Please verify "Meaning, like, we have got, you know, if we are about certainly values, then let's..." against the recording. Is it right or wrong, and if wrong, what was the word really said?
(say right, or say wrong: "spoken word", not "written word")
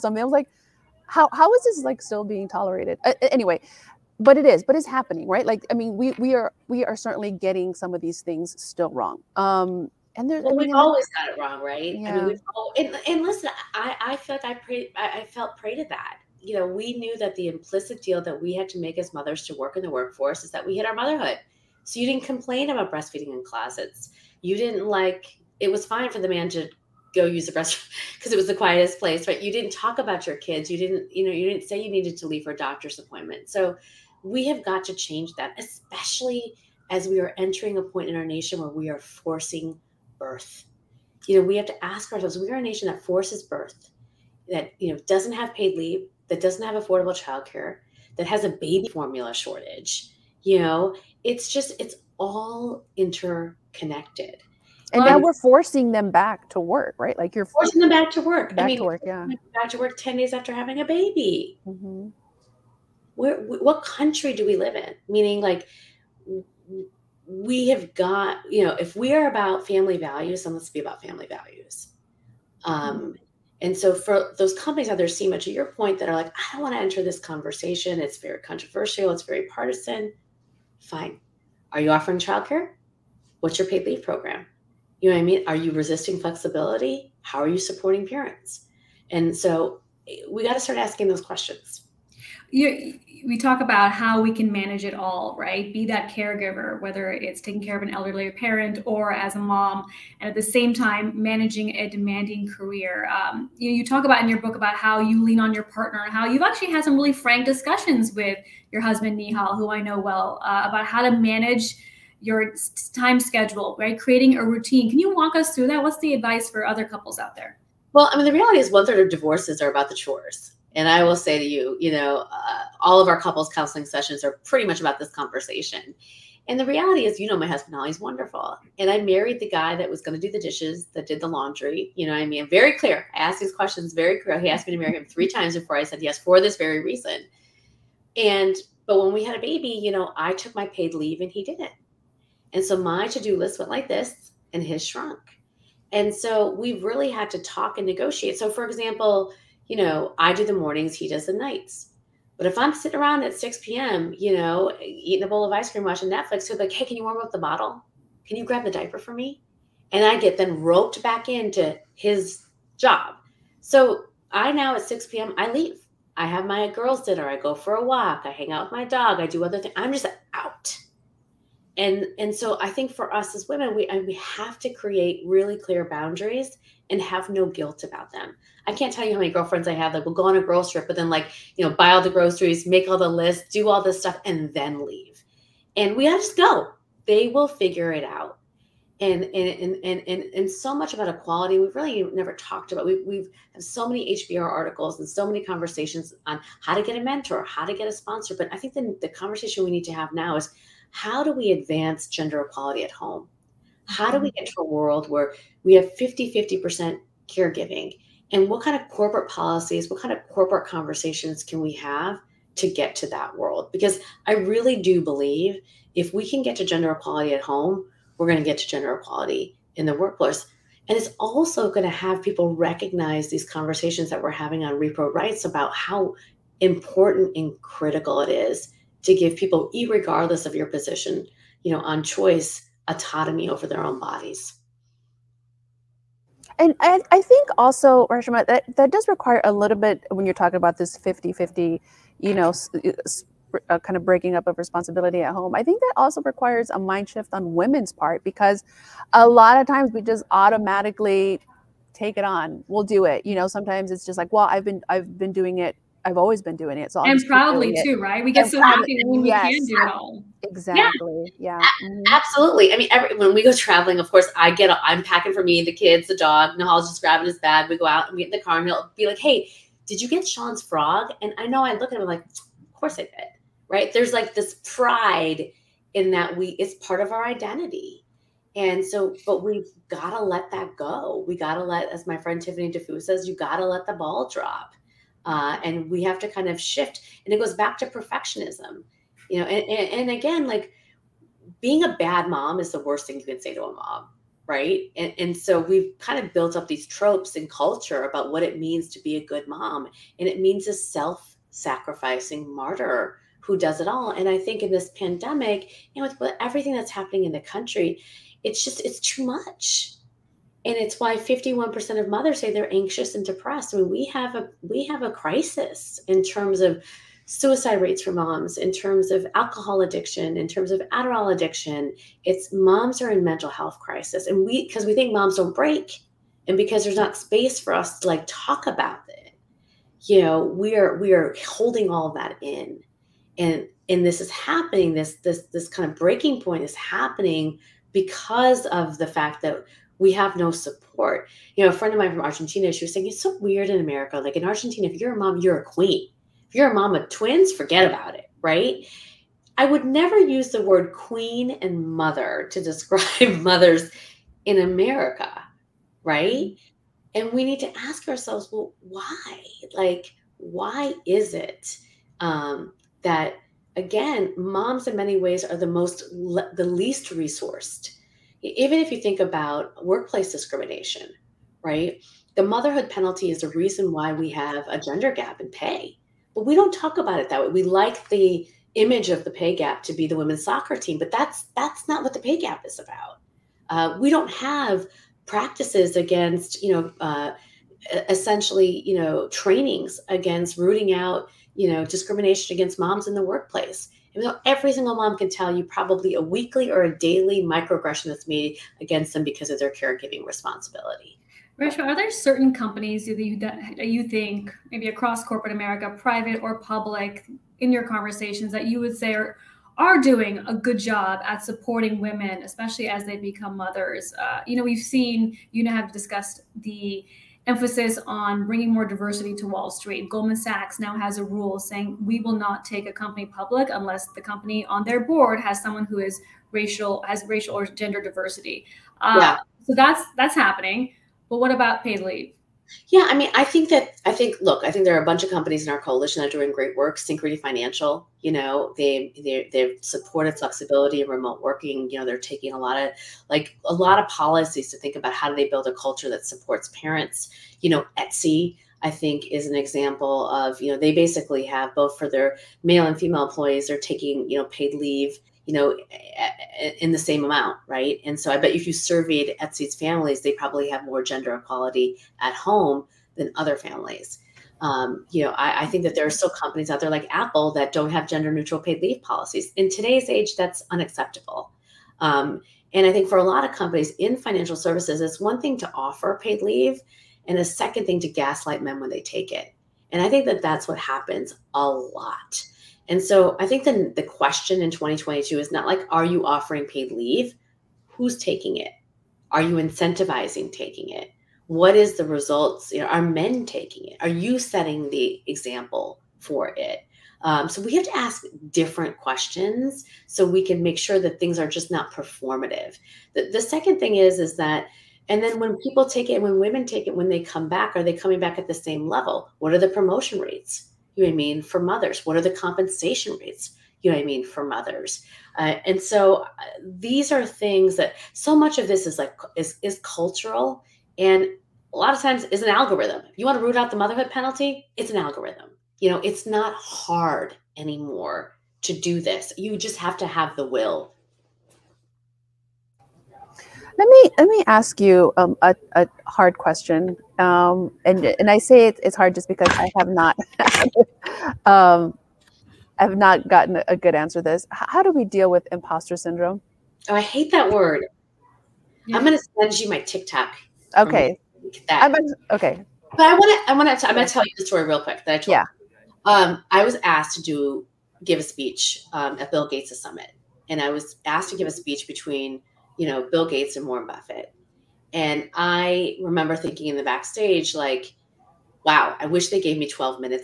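wrong: "family", not "certainly".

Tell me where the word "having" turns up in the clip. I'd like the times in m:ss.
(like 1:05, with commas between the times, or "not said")
1:00, 3:44.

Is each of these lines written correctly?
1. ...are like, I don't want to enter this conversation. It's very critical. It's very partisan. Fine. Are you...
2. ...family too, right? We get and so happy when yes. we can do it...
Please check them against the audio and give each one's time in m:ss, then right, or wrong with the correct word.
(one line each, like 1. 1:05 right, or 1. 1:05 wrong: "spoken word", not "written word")
1. 1:16 wrong: "controversial", not "critical"
2. 4:17 wrong: "proudly", not "family".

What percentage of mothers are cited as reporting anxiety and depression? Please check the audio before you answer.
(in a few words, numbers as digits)
51%.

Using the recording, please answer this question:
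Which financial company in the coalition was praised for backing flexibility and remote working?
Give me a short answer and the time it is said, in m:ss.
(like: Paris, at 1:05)
Synchrony Financial, at 7:16.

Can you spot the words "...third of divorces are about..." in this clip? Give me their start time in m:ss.
1:58.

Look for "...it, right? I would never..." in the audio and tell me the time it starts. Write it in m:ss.
5:48.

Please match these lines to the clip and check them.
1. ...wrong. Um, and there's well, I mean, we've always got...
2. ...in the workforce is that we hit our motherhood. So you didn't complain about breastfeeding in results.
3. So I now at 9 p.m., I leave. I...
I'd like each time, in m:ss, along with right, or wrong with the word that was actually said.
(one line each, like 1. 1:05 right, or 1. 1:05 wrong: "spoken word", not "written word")
1. 0:08 right
2. 0:19 wrong: "closets", not "results"
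3. 2:43 wrong: "6", not "9".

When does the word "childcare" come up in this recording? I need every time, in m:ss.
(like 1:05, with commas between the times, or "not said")
0:47, 1:22.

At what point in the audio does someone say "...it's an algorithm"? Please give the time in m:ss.
8:44.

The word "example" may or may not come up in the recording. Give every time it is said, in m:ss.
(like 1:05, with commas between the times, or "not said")
2:28, 7:29, 8:15.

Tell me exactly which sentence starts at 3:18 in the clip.
But I think the, the conversation we need to have now is how do we advance gender equality at home?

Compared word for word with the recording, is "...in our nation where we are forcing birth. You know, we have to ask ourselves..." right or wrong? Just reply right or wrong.
right.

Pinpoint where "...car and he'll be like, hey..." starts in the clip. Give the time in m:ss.
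4:28.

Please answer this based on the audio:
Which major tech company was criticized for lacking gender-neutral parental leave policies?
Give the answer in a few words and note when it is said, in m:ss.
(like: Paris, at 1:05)
Apple, at 7:47.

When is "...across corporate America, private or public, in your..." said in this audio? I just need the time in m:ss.
6:44.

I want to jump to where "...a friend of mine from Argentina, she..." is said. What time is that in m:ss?
5:41.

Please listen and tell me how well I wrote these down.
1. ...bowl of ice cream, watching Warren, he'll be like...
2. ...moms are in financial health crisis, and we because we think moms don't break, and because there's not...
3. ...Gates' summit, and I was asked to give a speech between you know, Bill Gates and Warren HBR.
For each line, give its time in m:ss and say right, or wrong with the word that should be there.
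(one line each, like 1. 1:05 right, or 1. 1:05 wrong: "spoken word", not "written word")
1. 2:35 wrong: "Netflix", not "Warren"
2. 5:22 wrong: "mental", not "financial"
3. 9:19 wrong: "Buffett", not "HBR".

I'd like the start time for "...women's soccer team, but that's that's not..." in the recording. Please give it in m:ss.
6:20.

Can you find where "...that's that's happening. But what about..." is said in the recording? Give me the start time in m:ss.
7:09.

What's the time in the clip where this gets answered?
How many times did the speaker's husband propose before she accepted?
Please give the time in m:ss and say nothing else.
2:15.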